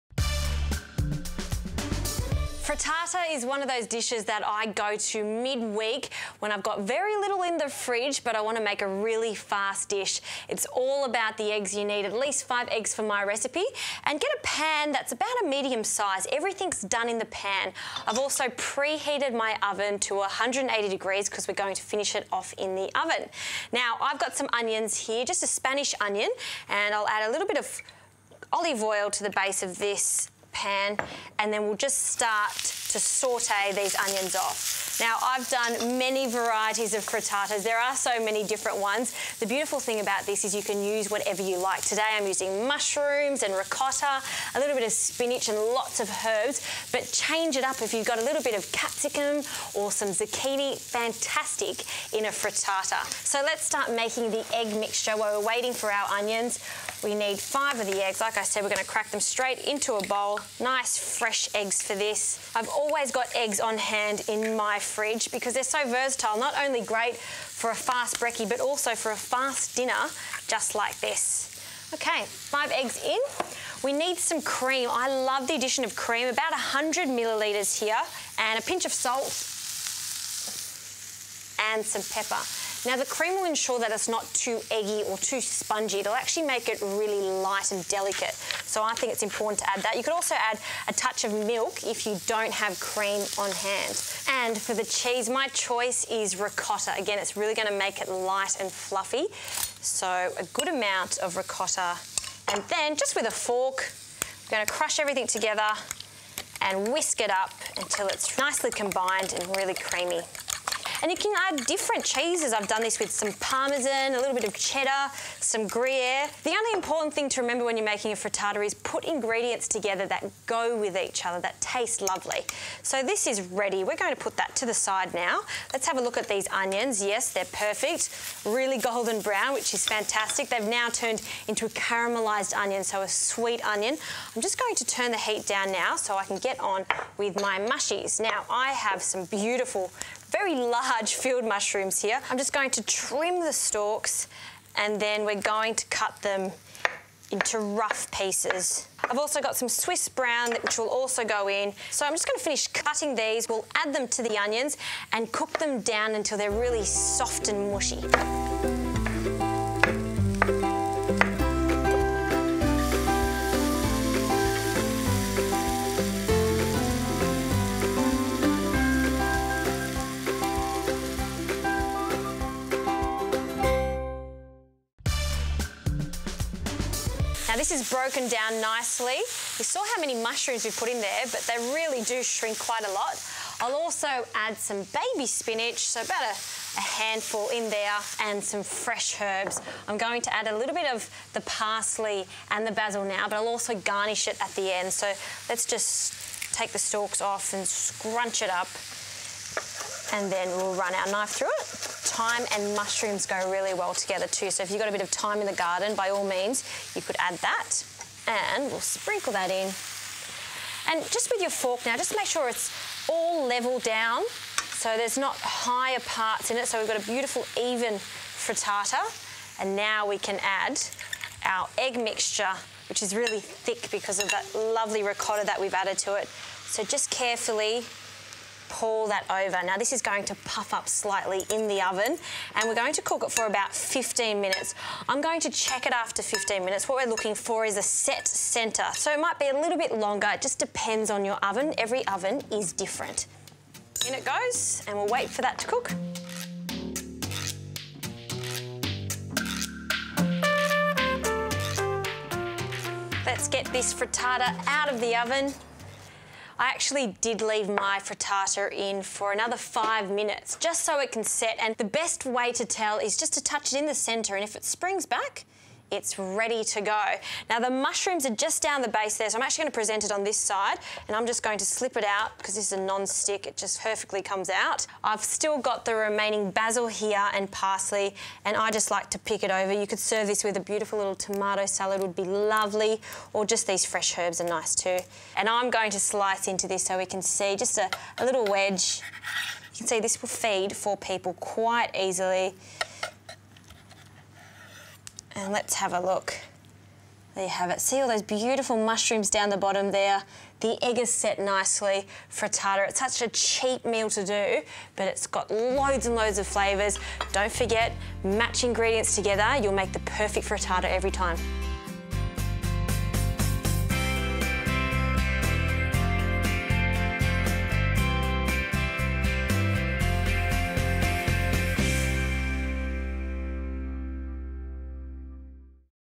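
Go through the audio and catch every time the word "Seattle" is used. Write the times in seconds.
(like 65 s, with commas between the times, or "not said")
not said.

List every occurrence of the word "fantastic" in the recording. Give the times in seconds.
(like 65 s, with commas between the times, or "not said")
50 s, 129 s.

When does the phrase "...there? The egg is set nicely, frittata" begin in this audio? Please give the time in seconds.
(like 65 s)
299 s.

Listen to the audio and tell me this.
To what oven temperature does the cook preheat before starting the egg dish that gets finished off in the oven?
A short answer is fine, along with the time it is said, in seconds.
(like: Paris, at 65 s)
180 degrees, at 20 s.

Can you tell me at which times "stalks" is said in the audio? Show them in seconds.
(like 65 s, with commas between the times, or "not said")
143 s, 196 s.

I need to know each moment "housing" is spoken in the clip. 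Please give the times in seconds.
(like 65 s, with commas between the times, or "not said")
not said.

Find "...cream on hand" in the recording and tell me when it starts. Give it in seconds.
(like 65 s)
92 s.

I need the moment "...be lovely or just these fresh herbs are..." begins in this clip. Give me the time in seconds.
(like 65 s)
282 s.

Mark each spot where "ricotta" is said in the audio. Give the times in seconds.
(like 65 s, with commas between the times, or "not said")
43 s, 96 s, 101 s, 225 s.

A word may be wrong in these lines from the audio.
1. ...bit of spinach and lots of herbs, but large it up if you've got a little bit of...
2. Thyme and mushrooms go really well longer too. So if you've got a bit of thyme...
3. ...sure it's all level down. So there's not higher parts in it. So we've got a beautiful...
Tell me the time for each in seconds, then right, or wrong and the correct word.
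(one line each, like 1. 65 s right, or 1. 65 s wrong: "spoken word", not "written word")
1. 44 s wrong: "change", not "large"
2. 202 s wrong: "together", not "longer"
3. 212 s right.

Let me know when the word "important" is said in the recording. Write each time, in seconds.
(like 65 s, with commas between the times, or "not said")
89 s, 116 s.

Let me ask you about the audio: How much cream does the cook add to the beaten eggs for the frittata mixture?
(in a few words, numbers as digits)
100 millilitres.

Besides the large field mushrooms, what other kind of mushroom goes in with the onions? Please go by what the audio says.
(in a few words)
Swiss brown.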